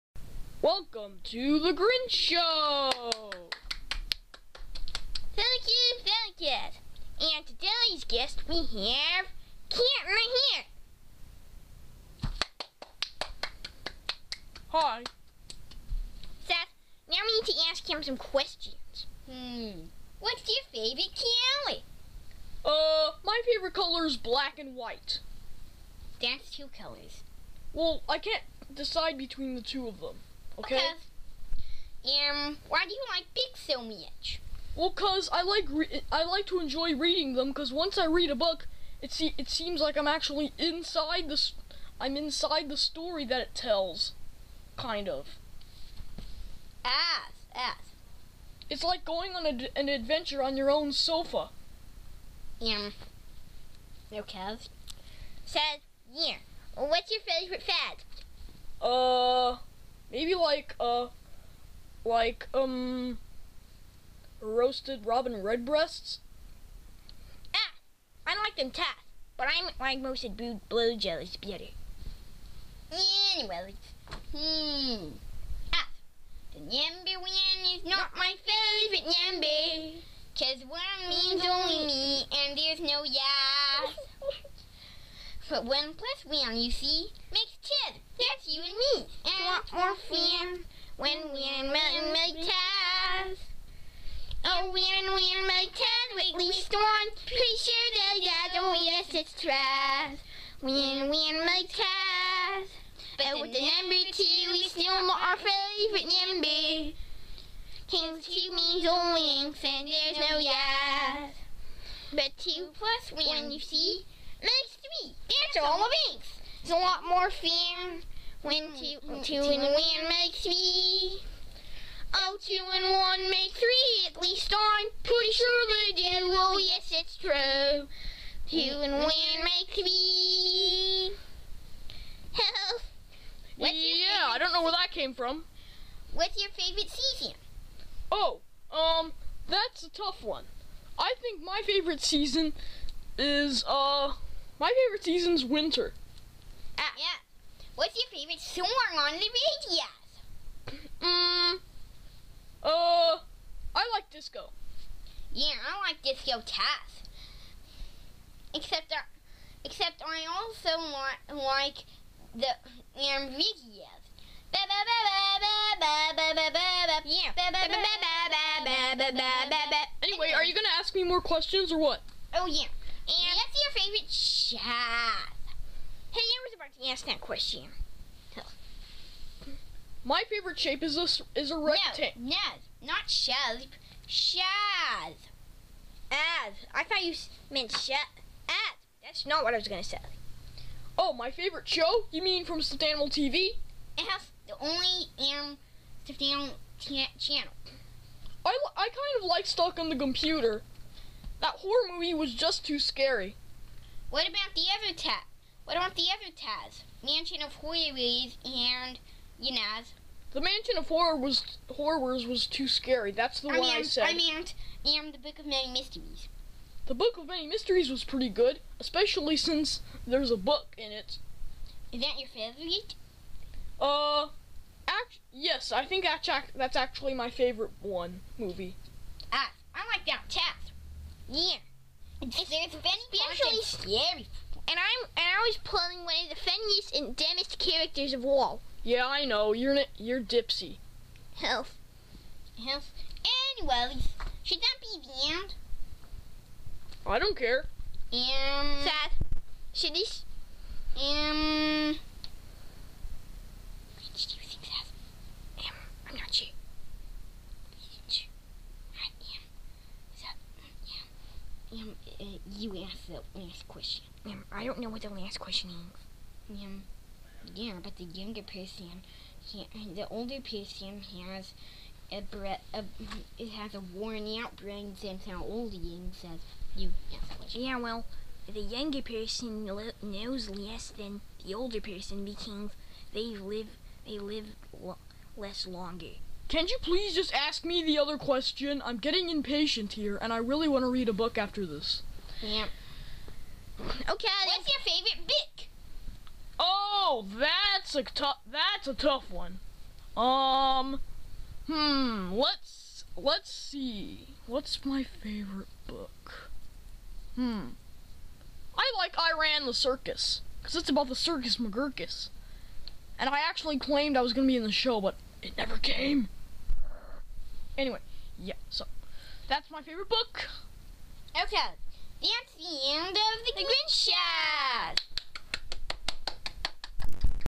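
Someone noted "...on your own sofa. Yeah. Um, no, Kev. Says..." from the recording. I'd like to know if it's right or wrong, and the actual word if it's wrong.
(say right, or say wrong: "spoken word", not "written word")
right.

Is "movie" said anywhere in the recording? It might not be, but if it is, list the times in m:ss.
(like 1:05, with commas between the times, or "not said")
3:21, 3:48.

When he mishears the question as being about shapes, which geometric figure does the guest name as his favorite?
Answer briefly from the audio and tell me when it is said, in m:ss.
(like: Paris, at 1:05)
rectangle, at 3:01.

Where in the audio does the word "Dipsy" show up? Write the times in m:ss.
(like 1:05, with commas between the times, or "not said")
4:00.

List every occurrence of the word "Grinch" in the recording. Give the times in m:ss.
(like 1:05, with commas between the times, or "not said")
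0:01, 5:23.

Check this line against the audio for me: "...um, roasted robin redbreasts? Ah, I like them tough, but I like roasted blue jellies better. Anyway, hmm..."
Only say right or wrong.
right.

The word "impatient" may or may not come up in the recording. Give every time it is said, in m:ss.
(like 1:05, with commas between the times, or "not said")
4:49.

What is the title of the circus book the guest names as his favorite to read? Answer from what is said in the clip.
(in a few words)
I Ran the Circus.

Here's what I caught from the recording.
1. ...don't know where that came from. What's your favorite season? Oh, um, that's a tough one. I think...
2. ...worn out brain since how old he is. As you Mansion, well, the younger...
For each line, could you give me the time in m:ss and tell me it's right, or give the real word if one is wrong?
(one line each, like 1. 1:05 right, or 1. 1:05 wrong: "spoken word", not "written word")
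1. 2:14 right
2. 4:33 wrong: "Yeah", not "Mansion".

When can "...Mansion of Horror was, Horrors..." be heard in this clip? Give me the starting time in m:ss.
3:30.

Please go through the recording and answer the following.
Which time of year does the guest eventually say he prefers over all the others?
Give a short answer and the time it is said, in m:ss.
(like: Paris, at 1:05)
winter, at 2:25.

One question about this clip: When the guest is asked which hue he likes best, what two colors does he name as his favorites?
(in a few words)
black and white.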